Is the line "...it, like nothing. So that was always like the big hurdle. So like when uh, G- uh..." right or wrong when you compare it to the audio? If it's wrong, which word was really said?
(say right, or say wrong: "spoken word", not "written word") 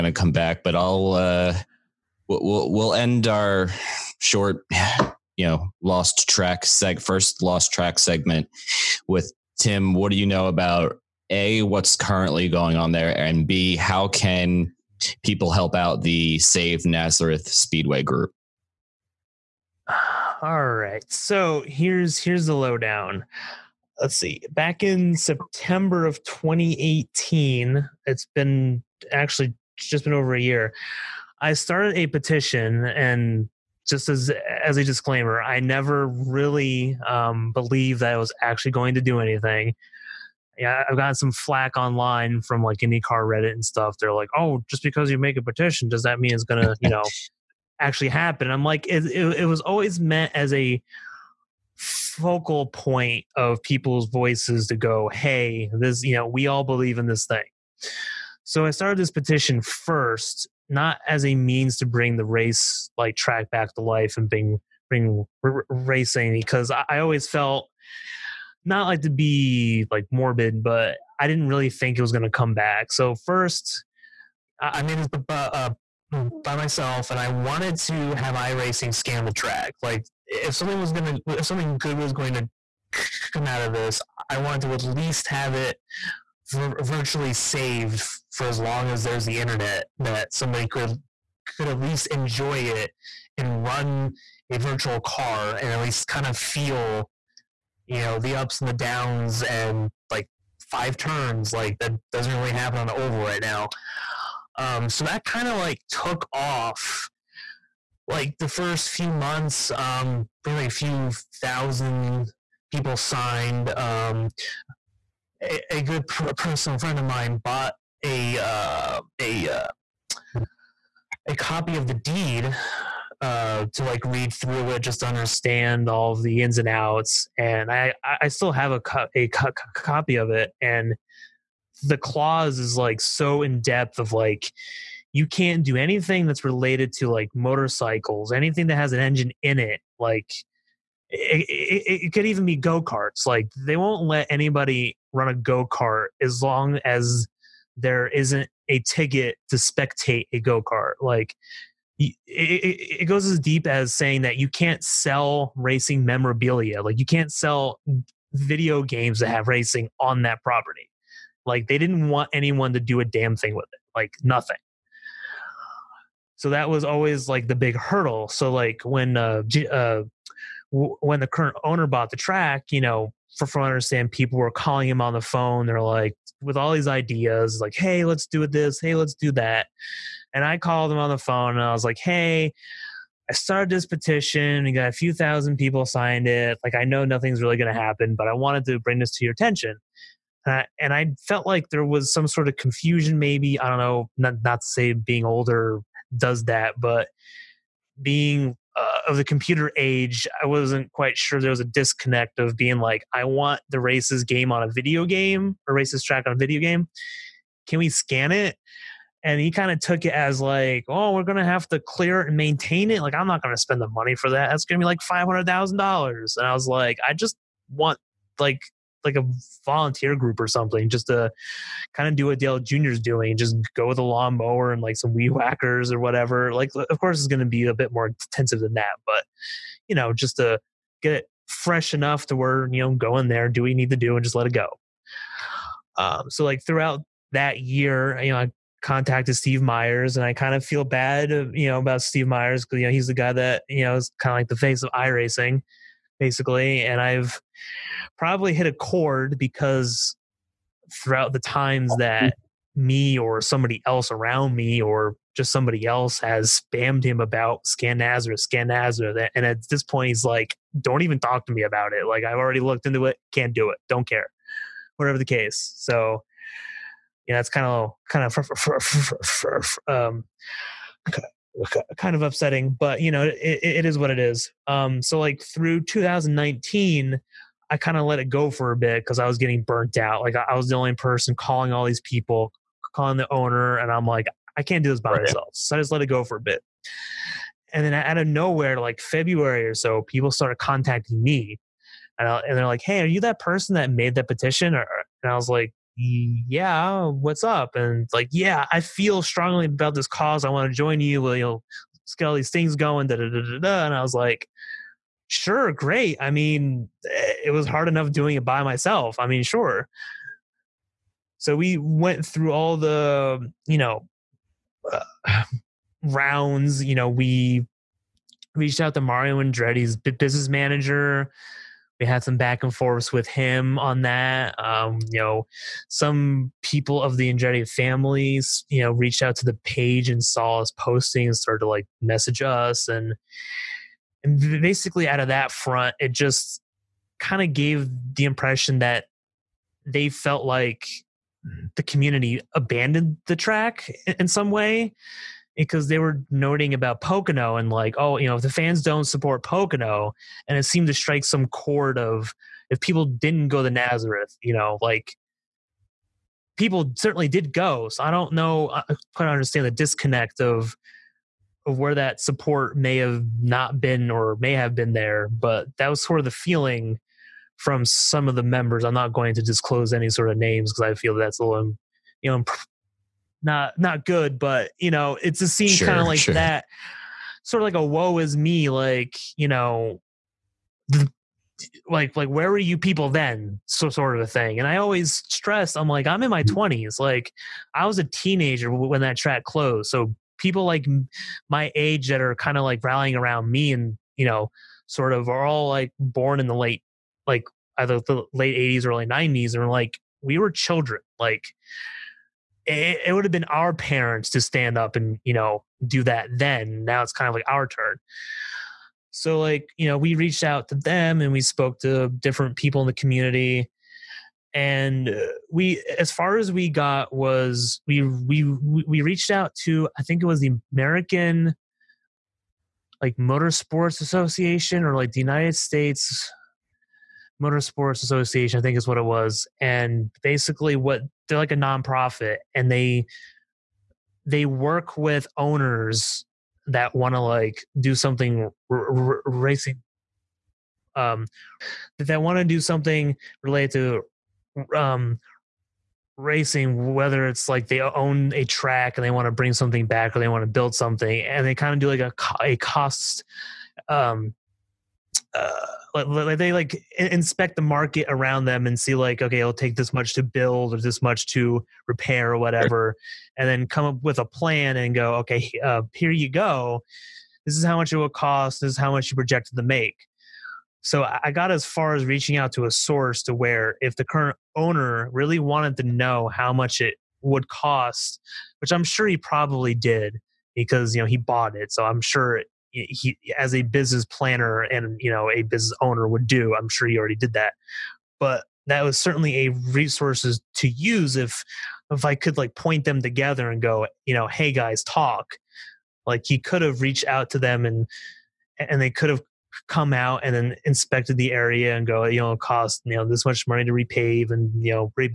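right.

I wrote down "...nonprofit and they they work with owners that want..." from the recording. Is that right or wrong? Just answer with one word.
right.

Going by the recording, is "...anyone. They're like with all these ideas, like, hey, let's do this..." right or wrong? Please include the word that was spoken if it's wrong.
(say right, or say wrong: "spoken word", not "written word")
wrong: "phone", not "anyone".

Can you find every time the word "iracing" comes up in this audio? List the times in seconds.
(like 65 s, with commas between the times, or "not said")
78 s, 244 s.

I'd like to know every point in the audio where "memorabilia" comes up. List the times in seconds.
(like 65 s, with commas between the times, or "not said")
156 s.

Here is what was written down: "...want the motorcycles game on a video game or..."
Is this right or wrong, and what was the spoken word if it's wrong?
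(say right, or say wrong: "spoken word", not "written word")
wrong: "races", not "motorcycles".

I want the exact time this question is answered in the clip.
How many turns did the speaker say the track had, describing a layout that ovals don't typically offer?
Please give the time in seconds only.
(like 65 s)
100 s.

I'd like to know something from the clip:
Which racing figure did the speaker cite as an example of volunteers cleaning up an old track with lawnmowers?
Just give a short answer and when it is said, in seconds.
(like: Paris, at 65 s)
Dale Jr., at 222 s.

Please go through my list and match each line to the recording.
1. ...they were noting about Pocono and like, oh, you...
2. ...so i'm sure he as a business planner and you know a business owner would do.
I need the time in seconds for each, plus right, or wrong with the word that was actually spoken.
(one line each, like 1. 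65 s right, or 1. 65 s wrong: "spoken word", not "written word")
1. 345 s right
2. 481 s right.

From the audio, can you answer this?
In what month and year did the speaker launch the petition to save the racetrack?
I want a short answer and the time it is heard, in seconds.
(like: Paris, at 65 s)
September 2018, at 25 s.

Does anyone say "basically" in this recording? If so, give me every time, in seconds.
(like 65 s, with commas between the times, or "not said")
246 s, 334 s, 430 s.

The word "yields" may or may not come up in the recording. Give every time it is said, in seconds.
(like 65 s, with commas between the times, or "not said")
not said.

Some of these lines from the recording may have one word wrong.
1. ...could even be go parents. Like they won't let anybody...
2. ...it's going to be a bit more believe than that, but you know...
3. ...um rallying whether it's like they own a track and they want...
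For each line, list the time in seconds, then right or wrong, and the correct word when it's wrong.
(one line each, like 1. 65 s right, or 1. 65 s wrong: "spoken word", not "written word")
1. 142 s wrong: "karts", not "parents"
2. 227 s wrong: "intensive", not "believe"
3. 444 s wrong: "racing", not "rallying".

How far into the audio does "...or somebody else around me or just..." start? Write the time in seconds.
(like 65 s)
253 s.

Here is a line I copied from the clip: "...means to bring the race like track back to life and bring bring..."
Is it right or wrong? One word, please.
right.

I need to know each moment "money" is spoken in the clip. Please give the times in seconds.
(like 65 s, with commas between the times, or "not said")
213 s, 503 s.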